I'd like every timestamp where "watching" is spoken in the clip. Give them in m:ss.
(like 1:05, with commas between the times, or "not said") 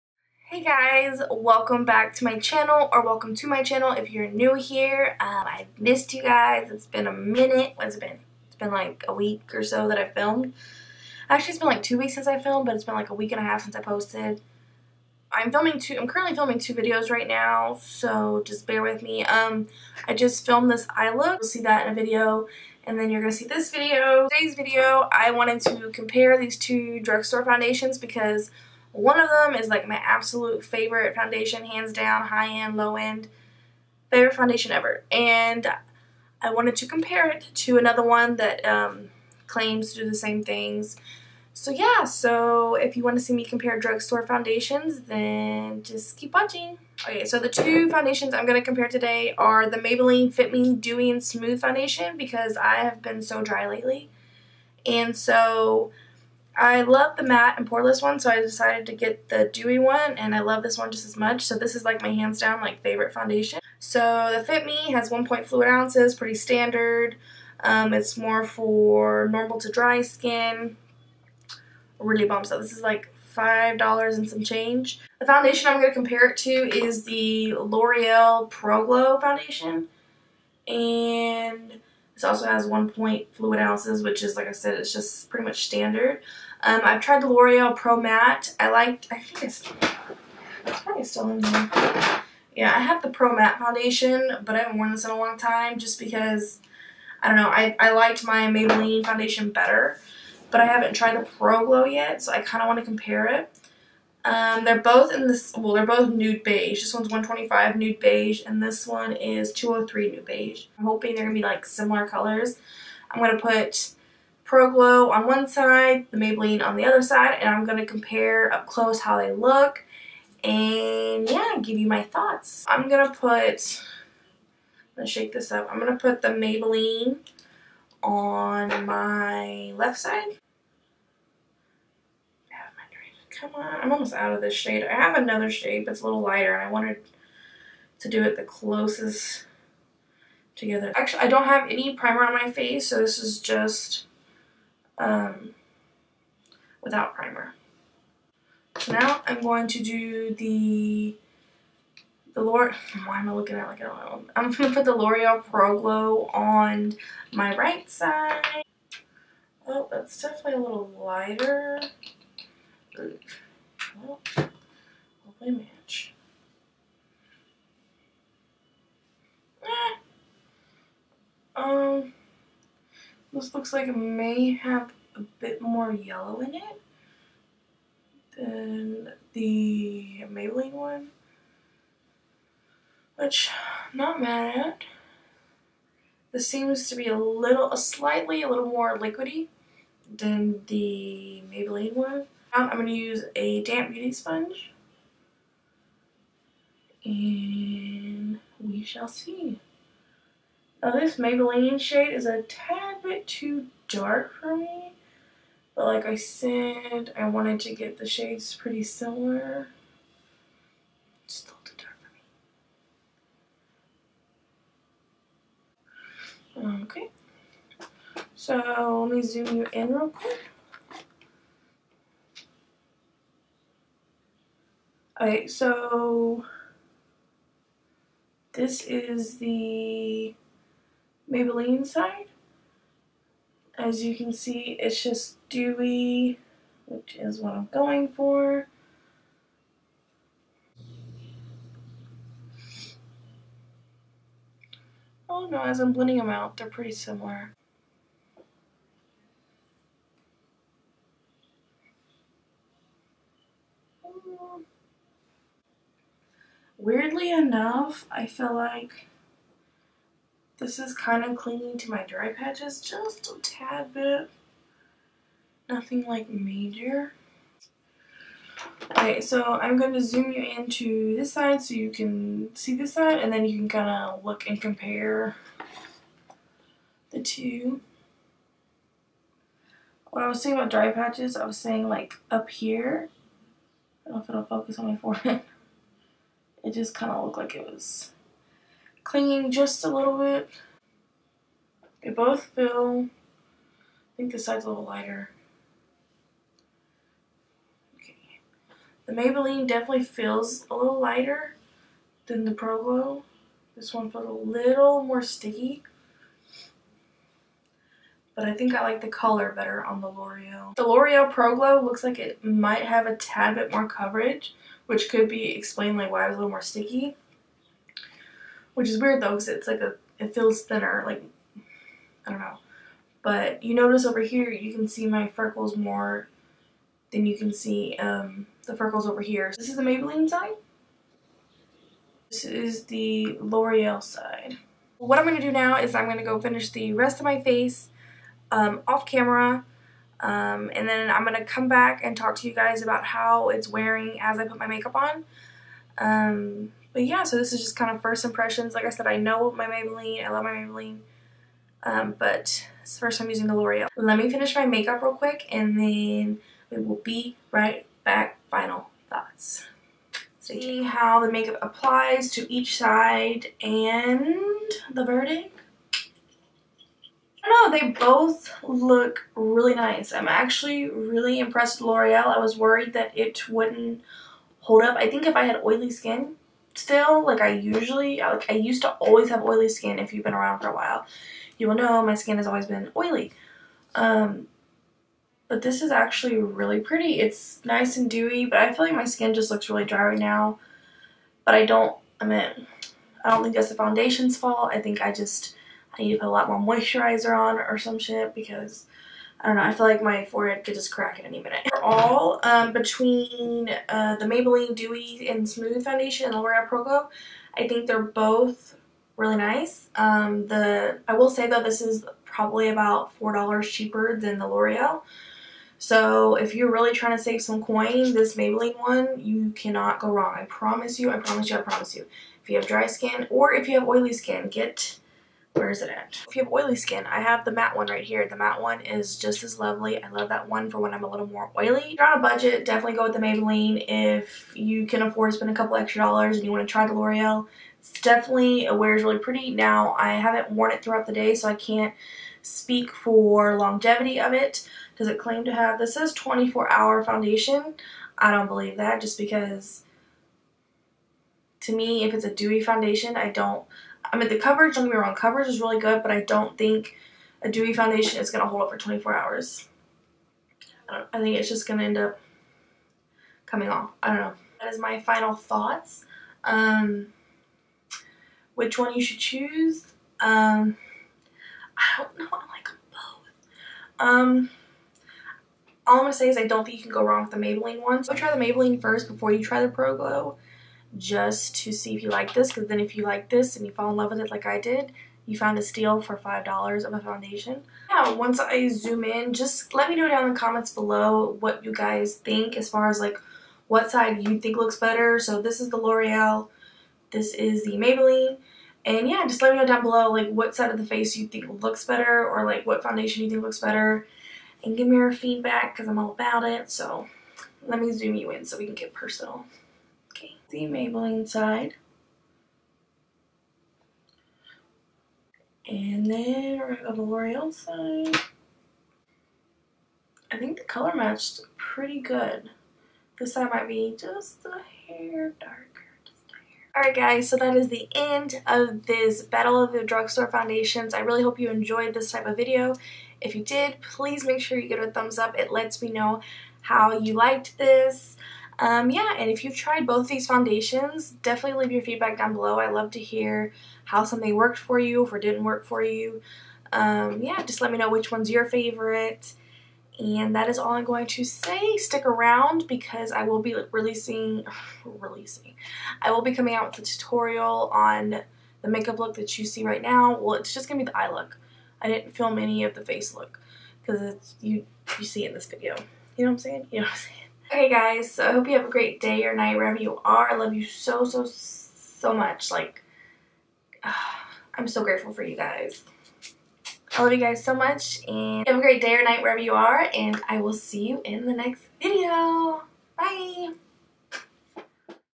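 0:46.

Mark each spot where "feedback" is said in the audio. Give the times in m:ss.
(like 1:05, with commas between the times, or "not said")
8:25, 9:01.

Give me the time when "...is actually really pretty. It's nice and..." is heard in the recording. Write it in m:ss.
6:25.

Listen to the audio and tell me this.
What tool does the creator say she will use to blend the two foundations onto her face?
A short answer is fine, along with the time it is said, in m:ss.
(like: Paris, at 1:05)
damp beauty sponge, at 3:13.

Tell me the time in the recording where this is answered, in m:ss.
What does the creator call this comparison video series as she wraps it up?
8:49.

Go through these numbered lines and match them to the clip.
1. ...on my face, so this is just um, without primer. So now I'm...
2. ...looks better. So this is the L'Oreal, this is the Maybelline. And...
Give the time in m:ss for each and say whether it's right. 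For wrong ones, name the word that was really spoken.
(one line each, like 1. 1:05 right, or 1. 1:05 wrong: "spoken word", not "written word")
1. 2:22 right
2. 8:14 right.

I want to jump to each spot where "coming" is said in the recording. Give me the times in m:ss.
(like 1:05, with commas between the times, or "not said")
7:43, 9:16.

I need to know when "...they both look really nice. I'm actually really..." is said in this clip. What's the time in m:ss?
6:07.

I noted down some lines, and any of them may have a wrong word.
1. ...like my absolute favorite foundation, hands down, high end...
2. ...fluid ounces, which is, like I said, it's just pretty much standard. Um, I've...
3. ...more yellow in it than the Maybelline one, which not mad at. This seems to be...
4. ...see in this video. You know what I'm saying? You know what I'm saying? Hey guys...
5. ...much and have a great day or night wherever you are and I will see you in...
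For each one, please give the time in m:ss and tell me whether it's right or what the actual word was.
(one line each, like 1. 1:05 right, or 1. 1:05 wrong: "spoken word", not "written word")
1. 0:29 right
2. 1:23 right
3. 2:55 right
4. 9:25 right
5. 9:37 right.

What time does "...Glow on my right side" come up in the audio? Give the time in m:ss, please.
2:35.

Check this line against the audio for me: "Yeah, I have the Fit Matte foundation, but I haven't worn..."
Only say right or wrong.
wrong.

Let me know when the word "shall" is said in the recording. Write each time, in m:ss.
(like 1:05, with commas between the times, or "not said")
3:18.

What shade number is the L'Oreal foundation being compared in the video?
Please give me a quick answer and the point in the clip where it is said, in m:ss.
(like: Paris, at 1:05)
203, at 1:49.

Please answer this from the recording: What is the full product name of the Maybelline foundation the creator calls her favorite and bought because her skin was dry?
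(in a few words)
Fit Me Dewy and Smooth.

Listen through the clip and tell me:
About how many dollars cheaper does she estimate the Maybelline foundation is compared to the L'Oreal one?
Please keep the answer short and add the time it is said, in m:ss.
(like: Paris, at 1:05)
4, at 6:53.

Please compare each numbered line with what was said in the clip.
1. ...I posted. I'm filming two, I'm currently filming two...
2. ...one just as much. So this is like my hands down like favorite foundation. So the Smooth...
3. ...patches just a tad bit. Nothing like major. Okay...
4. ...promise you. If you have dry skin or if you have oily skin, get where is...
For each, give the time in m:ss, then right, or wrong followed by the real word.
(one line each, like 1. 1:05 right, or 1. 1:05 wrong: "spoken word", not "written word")
1. 0:13 right
2. 1:00 wrong: "Fit", not "Smooth"
3. 4:22 right
4. 7:01 right.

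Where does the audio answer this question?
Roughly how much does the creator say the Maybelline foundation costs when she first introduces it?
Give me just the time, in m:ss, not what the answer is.
1:13.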